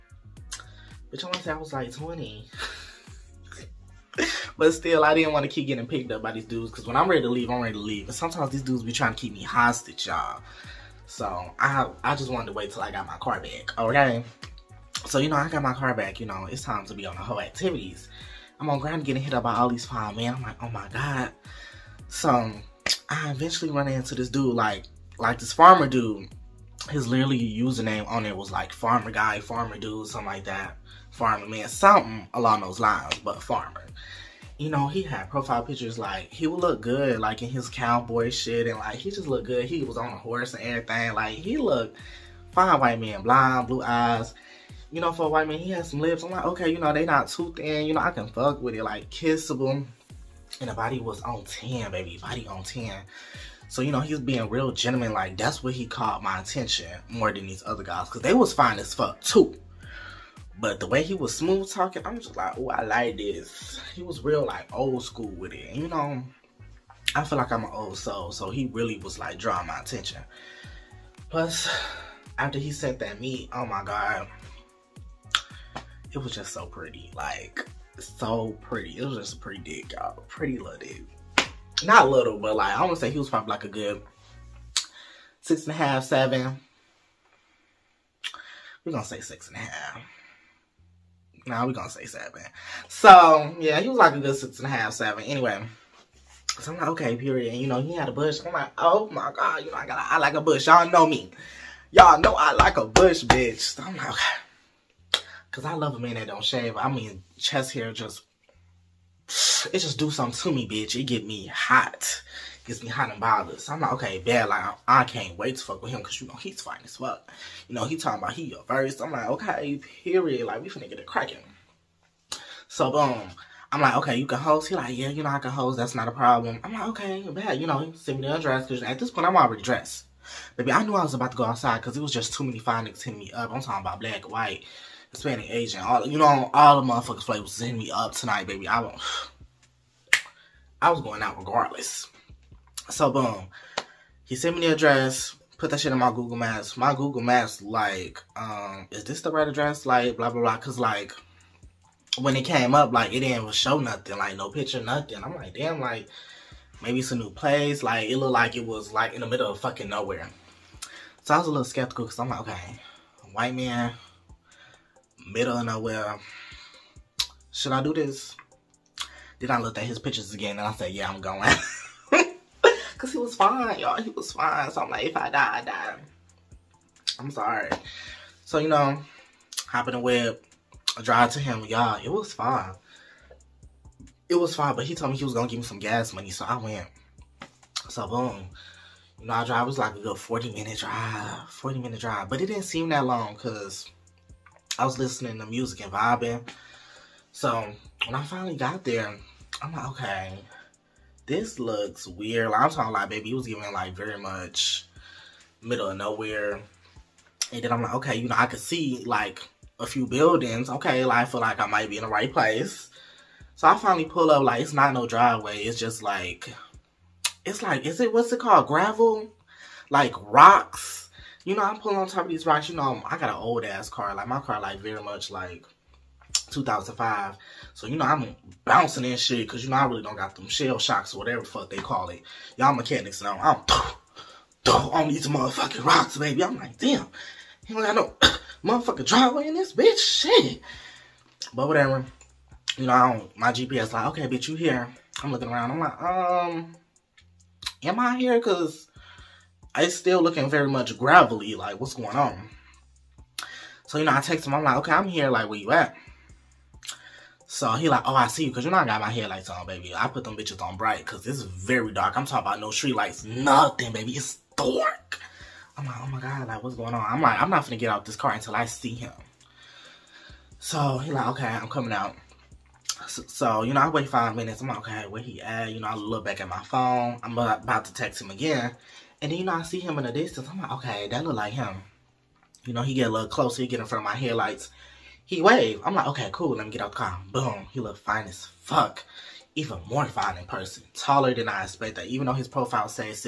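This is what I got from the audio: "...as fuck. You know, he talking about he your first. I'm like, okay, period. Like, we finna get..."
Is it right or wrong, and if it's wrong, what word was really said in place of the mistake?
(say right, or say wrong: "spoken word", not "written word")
right.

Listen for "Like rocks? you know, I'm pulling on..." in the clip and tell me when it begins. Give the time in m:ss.
3:39.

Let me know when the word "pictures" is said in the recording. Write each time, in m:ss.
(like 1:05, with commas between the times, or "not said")
0:35, 2:34, 2:49.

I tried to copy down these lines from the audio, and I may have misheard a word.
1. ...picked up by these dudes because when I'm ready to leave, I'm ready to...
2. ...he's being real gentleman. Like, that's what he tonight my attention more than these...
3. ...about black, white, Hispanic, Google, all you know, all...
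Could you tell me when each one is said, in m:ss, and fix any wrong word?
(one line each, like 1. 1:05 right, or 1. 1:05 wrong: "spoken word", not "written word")
1. 0:05 right
2. 0:53 wrong: "caught", not "tonight"
3. 2:13 wrong: "Asian", not "Google".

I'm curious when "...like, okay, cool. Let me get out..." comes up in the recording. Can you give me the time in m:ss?
4:45.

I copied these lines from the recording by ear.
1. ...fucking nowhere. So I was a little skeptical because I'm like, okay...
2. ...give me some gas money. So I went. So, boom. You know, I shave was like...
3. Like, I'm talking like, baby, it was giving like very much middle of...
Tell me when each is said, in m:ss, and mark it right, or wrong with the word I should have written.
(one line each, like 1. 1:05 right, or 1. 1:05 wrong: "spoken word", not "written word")
1. 2:39 right
2. 3:05 wrong: "drive", not "shave"
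3. 3:22 right.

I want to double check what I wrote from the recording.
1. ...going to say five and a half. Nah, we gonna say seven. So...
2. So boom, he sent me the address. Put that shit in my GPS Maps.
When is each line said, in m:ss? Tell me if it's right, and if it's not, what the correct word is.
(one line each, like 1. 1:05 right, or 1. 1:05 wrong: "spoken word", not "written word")
1. 1:28 wrong: "six", not "five"
2. 2:22 wrong: "Google", not "GPS".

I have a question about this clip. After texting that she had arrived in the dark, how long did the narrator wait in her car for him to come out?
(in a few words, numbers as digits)
5 minutes.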